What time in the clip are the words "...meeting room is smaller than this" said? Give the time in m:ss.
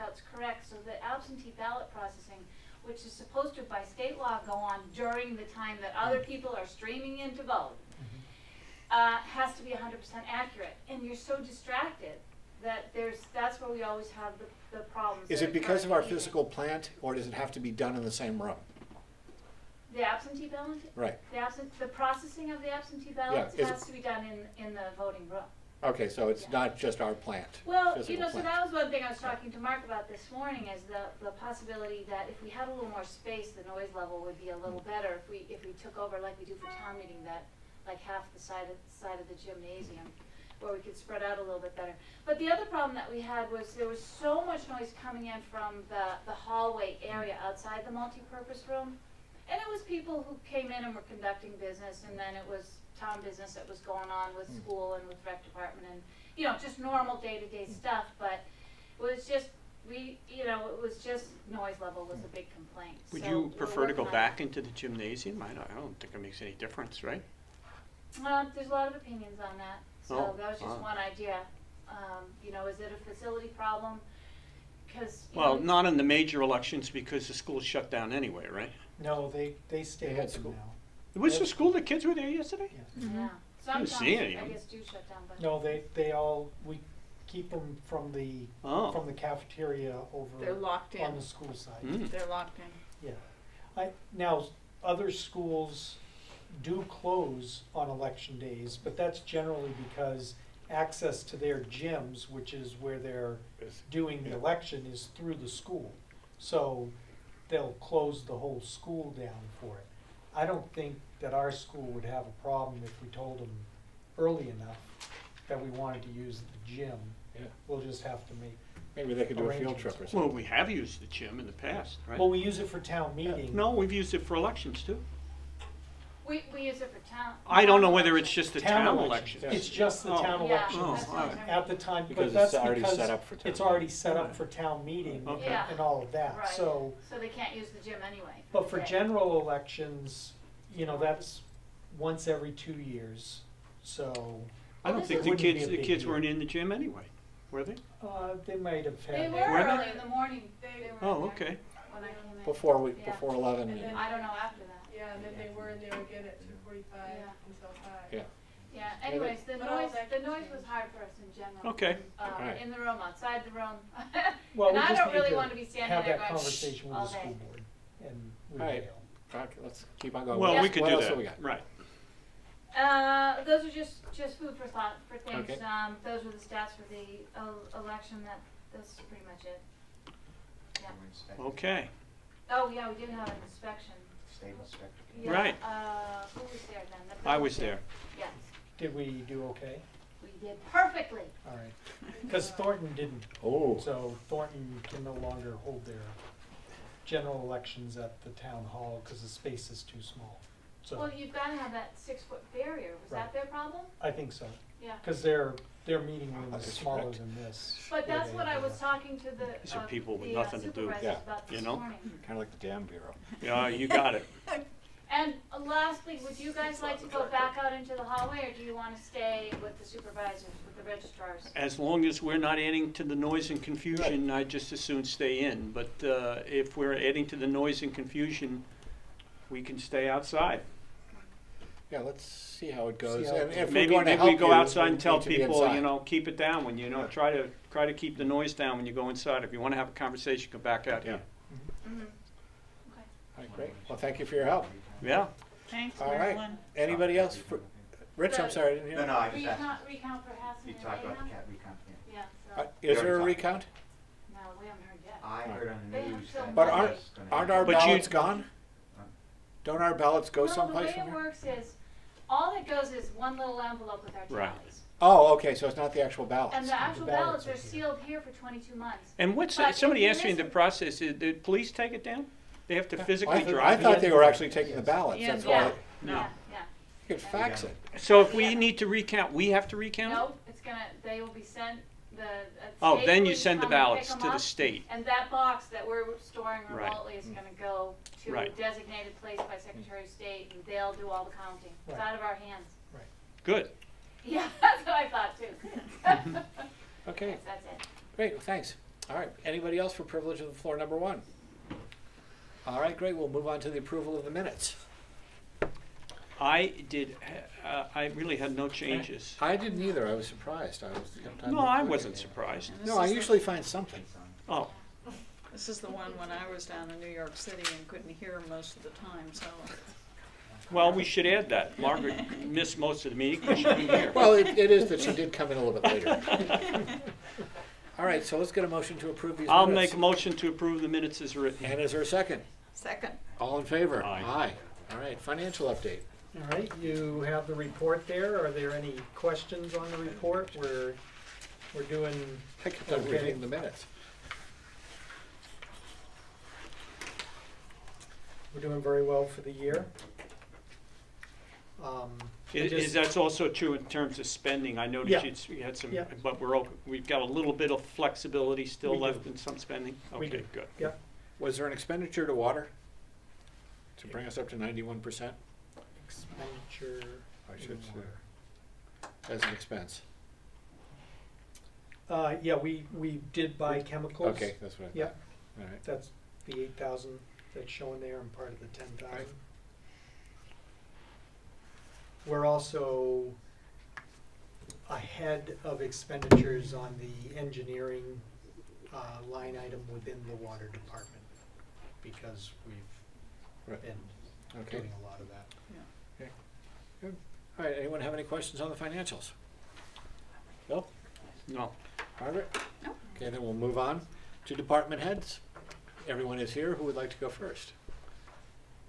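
3:25.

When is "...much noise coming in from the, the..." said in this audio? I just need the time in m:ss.
0:44.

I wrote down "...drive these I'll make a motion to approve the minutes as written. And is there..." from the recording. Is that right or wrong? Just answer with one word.
wrong.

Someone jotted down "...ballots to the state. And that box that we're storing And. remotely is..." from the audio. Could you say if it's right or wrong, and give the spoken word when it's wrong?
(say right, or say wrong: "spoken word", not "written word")
wrong: "Right", not "And".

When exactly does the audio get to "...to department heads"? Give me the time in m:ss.
6:44.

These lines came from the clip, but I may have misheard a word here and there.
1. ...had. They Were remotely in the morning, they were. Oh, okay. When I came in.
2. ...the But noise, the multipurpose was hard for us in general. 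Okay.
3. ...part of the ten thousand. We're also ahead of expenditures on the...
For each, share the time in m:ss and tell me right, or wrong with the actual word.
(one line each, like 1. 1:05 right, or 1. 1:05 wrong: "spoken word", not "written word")
1. 2:29 wrong: "early", not "remotely"
2. 2:39 wrong: "noise", not "multipurpose"
3. 6:18 right.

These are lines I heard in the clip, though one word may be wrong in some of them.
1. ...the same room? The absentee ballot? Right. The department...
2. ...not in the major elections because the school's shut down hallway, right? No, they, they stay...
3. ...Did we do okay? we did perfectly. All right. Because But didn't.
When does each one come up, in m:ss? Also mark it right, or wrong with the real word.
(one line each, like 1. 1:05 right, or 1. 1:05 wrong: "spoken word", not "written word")
1. 0:18 wrong: "absent", not "department"
2. 1:15 wrong: "anyway", not "hallway"
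3. 3:08 wrong: "Thornton", not "But".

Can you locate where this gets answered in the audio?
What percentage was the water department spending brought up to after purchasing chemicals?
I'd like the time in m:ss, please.
6:04.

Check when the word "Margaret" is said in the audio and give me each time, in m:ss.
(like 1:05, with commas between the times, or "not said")
5:21, 6:42.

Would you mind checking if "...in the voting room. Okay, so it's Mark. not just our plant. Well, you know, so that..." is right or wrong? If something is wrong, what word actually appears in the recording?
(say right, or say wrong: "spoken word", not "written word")
wrong: "Yeah", not "Mark".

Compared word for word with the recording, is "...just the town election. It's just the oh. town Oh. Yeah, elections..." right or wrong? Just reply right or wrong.
right.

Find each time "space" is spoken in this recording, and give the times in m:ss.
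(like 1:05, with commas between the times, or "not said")
0:33, 3:19.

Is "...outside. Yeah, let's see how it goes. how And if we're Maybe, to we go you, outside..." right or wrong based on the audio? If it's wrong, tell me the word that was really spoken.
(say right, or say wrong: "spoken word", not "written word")
right.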